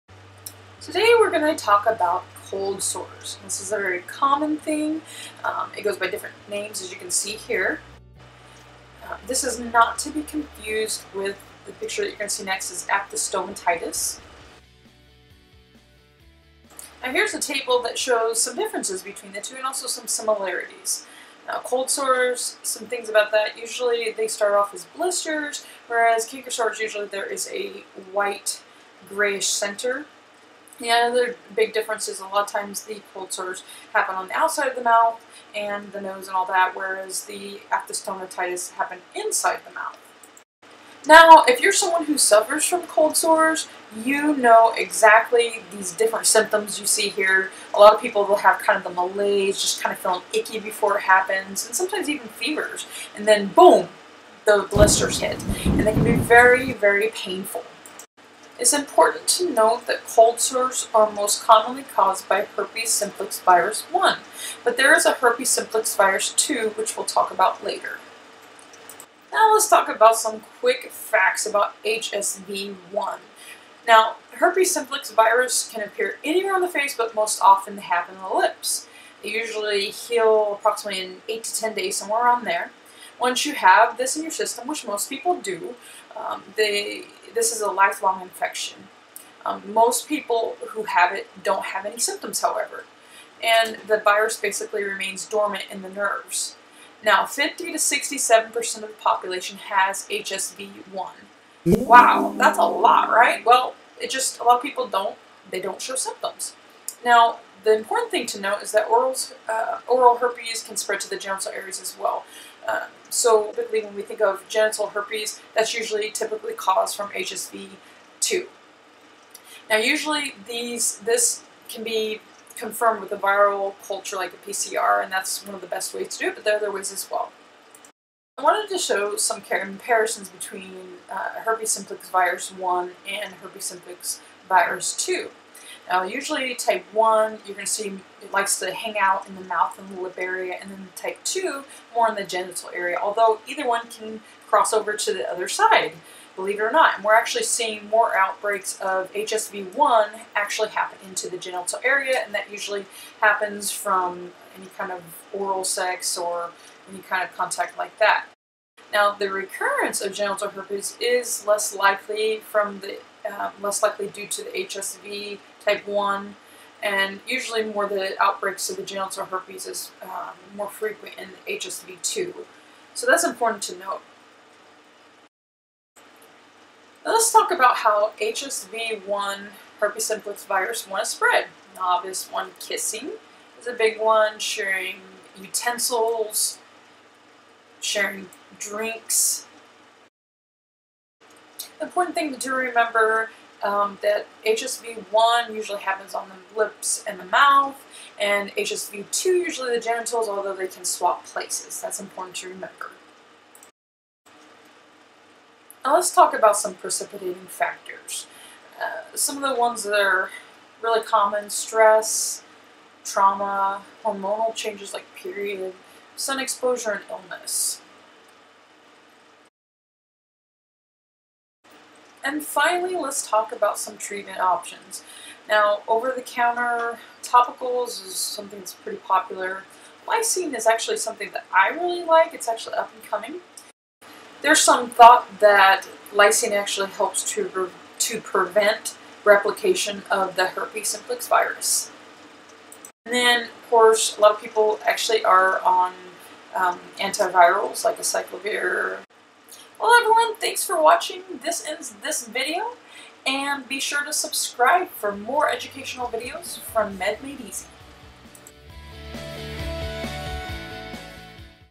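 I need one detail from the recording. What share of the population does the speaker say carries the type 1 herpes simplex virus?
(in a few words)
50 to 67%.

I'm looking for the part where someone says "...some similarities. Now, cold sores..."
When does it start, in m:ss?
0:19.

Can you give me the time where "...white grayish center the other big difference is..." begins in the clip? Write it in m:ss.
0:28.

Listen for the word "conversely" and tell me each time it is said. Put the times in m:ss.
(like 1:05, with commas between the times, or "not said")
not said.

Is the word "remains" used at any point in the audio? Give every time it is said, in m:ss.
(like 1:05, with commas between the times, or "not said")
1:34.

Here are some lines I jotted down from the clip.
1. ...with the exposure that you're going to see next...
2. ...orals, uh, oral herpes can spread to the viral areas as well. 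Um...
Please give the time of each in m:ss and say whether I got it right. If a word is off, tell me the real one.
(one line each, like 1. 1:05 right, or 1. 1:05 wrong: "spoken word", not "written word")
1. 0:11 wrong: "picture", not "exposure"
2. 1:48 wrong: "genital", not "viral".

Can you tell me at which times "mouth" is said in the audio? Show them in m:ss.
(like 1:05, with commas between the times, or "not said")
0:34, 0:39, 2:19, 3:17.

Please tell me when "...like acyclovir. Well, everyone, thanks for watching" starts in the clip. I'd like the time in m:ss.
4:07.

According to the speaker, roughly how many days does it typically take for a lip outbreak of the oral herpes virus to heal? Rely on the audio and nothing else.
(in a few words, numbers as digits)
8 to 10 days.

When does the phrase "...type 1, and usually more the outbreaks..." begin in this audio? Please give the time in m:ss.
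2:45.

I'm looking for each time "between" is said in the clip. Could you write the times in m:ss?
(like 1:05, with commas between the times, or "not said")
0:19, 2:10.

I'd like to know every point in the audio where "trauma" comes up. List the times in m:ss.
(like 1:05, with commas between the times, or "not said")
3:33.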